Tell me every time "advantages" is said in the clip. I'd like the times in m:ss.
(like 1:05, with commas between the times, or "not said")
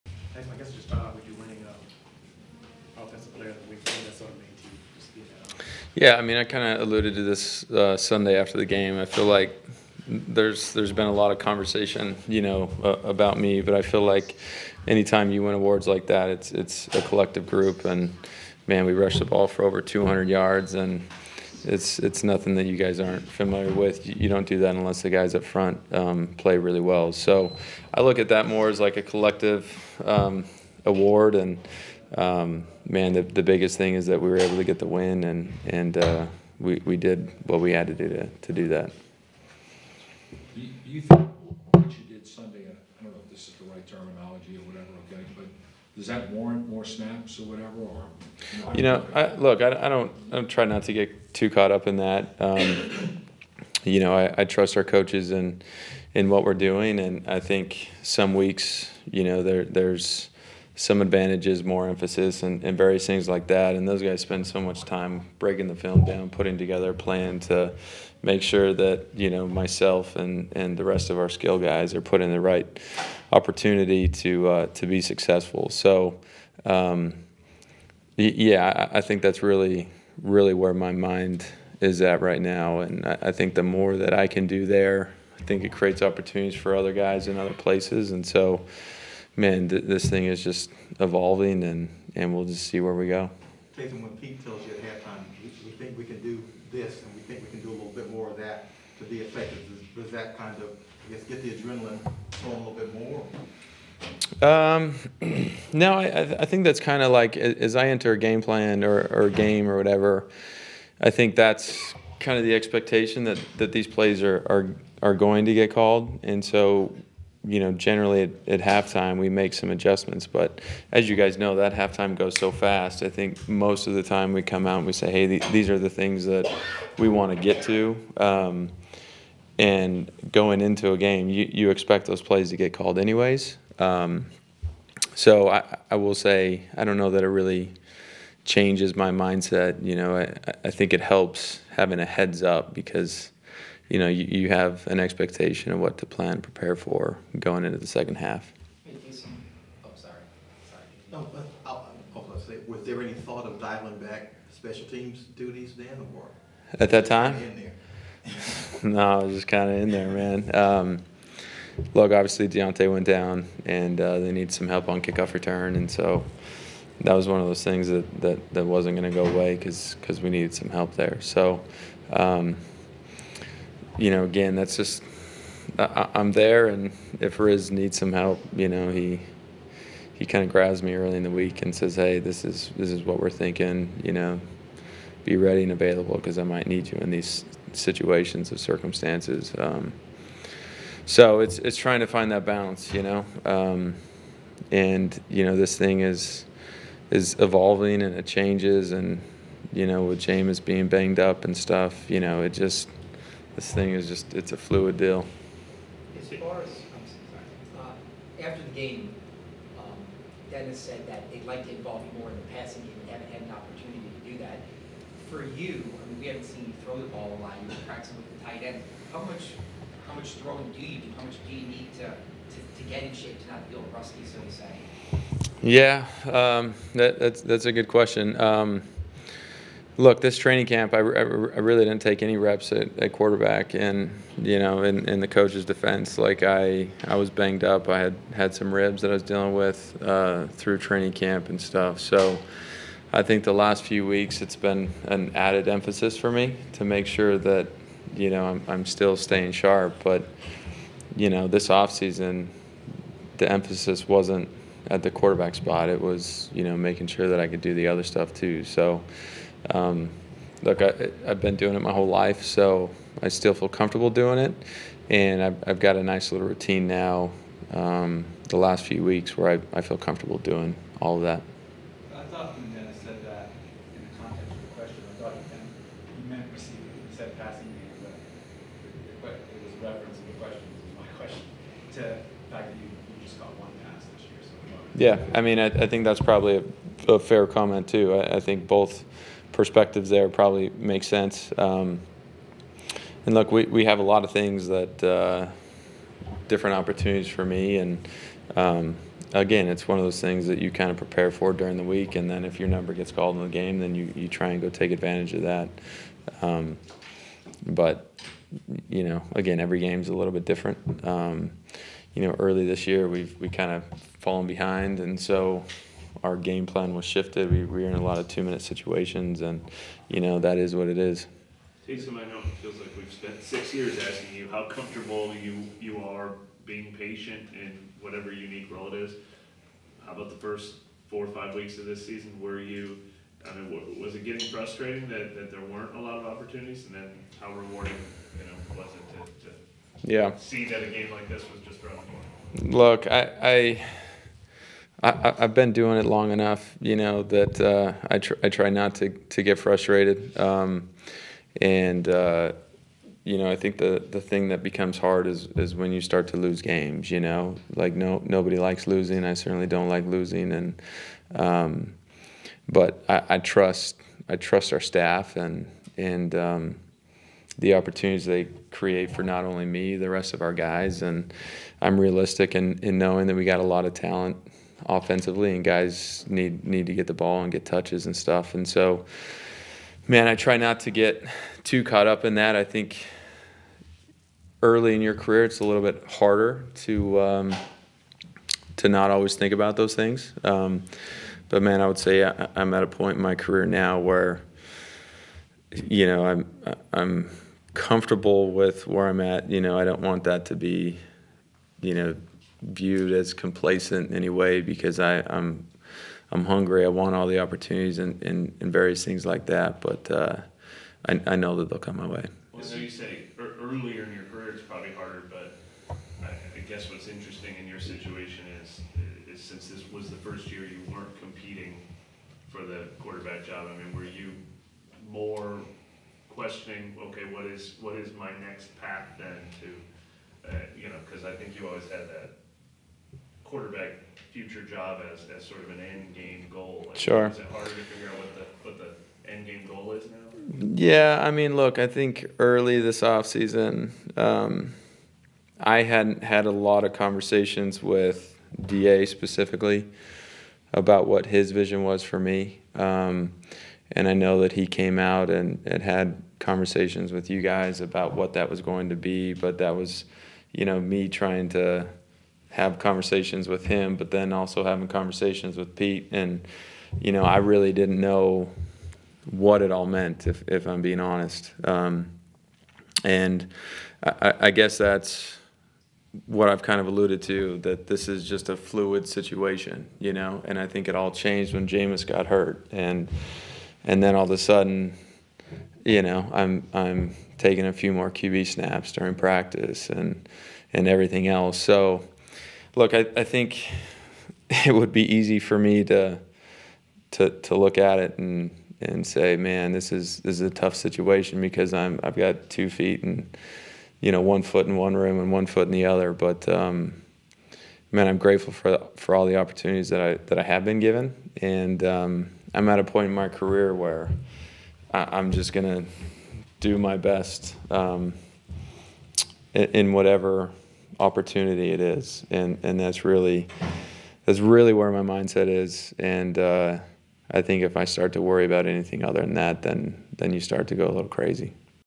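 1:01, 5:04.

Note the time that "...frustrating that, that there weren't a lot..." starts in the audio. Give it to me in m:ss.
5:34.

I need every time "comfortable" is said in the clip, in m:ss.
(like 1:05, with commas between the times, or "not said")
5:24, 6:37.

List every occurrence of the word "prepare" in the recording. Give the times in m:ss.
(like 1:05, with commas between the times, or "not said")
2:26, 5:00.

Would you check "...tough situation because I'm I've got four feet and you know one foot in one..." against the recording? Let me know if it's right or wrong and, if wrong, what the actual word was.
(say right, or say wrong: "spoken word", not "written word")
wrong: "two", not "four".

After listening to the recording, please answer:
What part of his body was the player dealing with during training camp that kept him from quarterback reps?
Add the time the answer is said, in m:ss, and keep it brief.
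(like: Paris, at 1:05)
Ribs, at 3:58.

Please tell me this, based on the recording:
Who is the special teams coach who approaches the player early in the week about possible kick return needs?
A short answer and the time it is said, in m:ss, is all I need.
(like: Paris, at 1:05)
Riz, at 2:57.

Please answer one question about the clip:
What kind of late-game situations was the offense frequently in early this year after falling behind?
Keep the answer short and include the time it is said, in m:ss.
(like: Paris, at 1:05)
Two minute situations, at 5:18.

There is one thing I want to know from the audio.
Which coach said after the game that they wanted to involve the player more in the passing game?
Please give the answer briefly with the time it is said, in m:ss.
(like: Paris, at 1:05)
Dennis, at 3:30.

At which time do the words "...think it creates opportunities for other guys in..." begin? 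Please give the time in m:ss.
1:25.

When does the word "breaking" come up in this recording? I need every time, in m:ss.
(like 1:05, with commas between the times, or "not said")
1:05.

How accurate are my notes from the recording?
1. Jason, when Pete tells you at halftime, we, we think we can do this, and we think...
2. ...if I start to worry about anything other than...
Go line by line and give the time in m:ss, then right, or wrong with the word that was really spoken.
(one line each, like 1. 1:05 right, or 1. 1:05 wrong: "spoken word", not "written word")
1. 1:33 right
2. 8:47 right.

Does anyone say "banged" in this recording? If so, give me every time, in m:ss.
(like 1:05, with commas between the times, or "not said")
3:20, 3:57.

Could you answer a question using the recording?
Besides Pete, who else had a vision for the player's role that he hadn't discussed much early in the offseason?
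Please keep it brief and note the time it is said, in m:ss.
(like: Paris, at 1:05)
DA, at 7:28.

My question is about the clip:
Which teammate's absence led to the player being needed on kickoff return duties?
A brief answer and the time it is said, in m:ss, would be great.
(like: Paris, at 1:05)
Deonte, at 2:42.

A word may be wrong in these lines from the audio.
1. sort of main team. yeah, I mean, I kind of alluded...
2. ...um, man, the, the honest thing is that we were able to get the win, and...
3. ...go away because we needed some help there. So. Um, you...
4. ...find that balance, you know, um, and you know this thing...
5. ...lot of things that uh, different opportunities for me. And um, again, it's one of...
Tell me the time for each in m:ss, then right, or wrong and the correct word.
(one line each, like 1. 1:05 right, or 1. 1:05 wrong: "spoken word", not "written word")
1. 0:04 right
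2. 0:32 wrong: "biggest", not "honest"
3. 2:49 right
4. 3:12 right
5. 4:54 right.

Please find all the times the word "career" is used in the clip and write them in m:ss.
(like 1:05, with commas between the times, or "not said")
6:25, 6:33, 6:54, 8:33.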